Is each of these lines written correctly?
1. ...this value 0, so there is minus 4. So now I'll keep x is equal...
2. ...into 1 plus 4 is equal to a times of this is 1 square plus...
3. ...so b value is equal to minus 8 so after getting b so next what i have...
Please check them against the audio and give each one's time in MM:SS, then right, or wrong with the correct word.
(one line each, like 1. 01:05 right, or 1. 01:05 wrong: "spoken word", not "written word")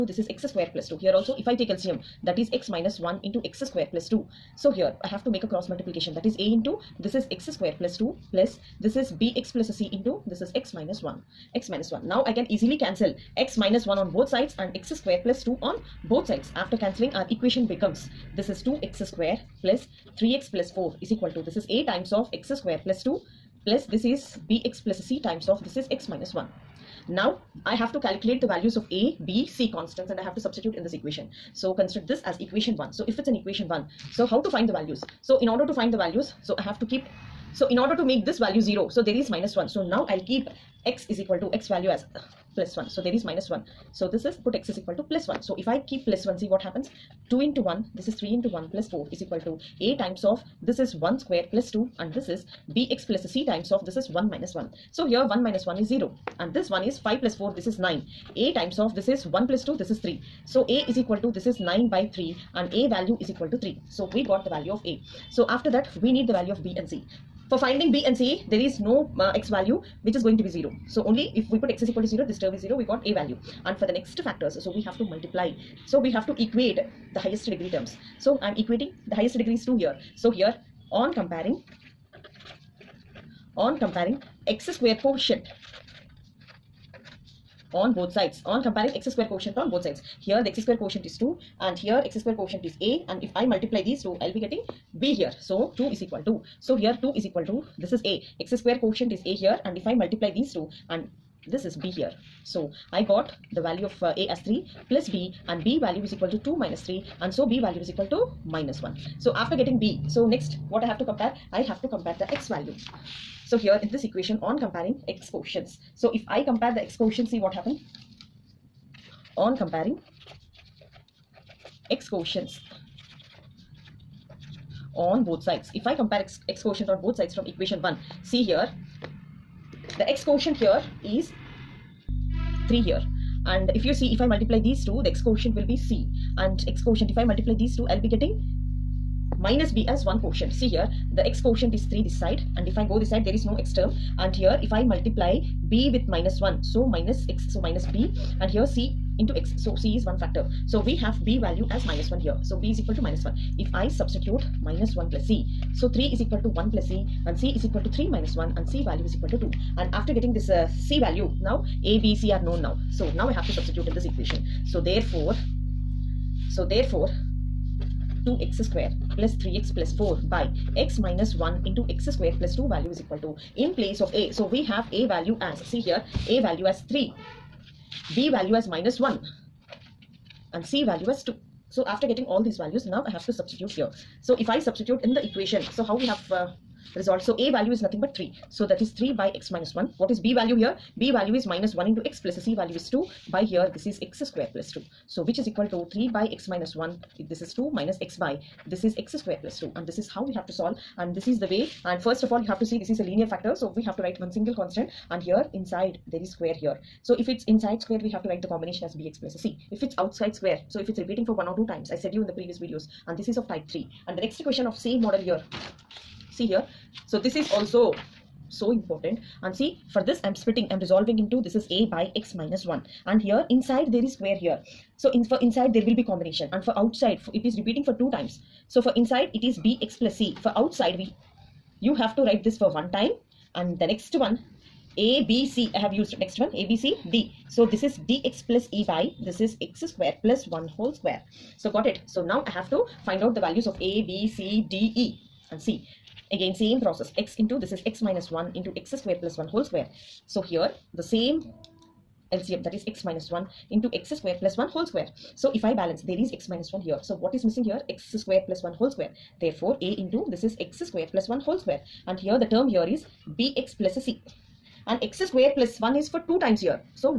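1. 00:38 wrong: "1", not "4"
2. 00:48 right
3. 01:47 wrong: "1", not "8".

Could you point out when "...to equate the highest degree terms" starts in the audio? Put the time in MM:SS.
01:16.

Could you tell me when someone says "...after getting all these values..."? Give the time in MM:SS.
03:01.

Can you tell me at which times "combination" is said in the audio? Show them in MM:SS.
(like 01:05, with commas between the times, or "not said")
03:28, 03:46.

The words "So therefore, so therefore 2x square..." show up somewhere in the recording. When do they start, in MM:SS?
02:44.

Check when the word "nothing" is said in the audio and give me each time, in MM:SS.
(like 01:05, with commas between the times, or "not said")
03:07.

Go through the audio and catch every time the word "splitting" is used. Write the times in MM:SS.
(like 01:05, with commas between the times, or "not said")
03:40.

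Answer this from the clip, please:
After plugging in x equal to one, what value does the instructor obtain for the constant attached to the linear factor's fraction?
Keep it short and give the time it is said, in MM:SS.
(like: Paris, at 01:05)
3, at 01:02.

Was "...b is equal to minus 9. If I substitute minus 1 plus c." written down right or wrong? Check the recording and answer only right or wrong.
wrong.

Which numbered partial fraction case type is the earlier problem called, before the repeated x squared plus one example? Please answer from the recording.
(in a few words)
type 3.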